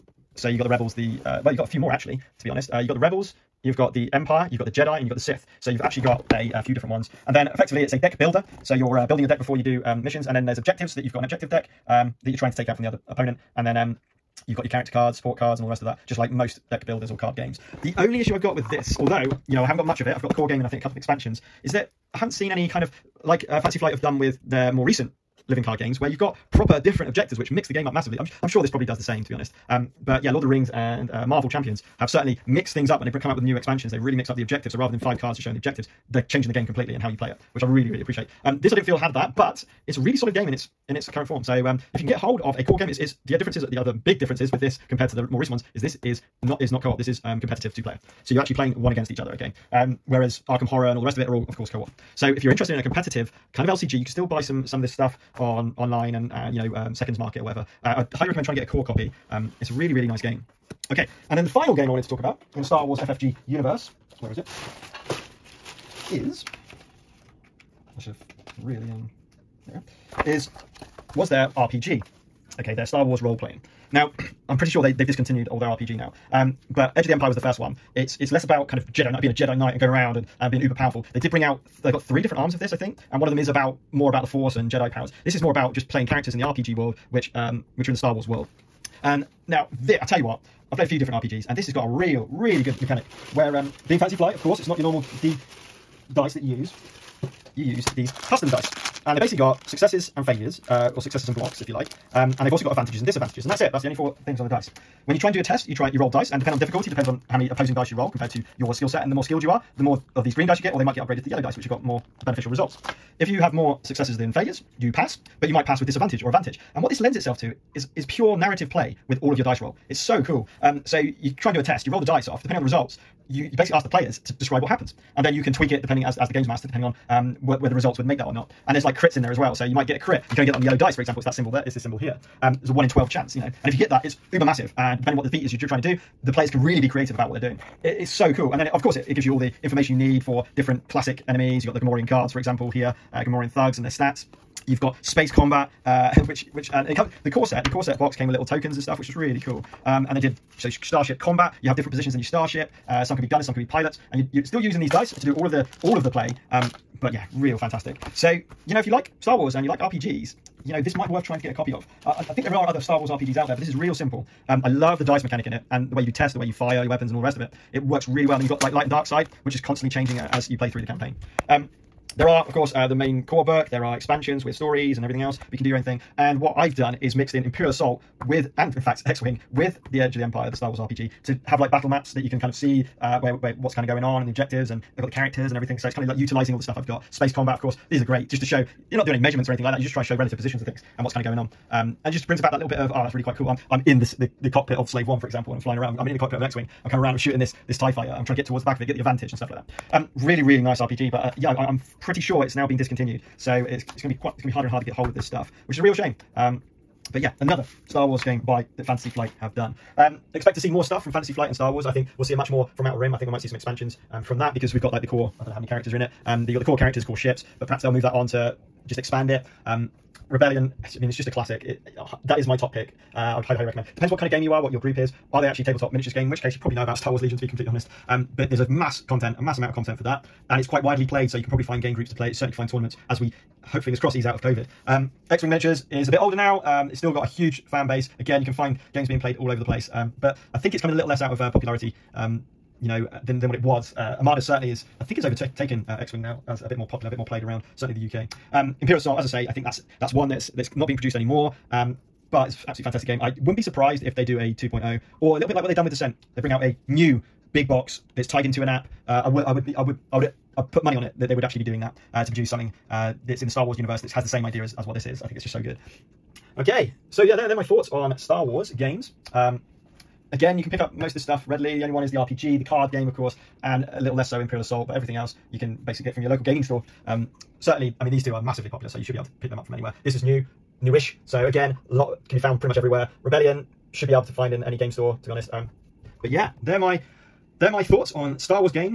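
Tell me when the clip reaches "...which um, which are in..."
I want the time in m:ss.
1:27.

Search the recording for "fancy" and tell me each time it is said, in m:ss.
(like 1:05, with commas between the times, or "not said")
0:23, 1:33.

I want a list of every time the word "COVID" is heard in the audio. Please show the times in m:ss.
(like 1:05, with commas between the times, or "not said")
3:54.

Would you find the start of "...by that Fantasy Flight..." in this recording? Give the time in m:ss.
3:28.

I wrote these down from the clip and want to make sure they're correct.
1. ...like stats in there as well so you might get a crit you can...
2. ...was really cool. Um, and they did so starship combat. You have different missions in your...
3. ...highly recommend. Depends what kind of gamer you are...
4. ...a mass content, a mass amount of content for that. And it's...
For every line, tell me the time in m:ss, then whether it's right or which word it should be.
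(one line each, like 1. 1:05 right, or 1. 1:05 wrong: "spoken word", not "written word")
1. 2:08 wrong: "crits", not "stats"
2. 2:29 wrong: "positions", not "missions"
3. 3:43 right
4. 3:48 right.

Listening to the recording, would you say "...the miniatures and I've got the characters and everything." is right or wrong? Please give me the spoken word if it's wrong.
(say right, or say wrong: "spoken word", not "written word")
wrong: "objectives", not "miniatures".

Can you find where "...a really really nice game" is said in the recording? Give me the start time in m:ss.
0:59.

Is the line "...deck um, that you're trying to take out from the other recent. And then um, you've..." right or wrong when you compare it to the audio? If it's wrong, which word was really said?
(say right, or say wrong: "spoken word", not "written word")
wrong: "opponent", not "recent".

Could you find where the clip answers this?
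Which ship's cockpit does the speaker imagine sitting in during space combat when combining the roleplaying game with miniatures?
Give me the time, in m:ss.
3:14.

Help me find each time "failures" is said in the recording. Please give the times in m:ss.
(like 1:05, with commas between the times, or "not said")
1:40, 1:54.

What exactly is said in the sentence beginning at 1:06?
Is I should have really um there is was there RPG?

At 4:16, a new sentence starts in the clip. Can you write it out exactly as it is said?
They bring out a new big box that's tied into an app.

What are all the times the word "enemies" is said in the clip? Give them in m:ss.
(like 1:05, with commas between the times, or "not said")
2:21.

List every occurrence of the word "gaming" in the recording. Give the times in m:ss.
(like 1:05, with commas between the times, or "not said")
4:36.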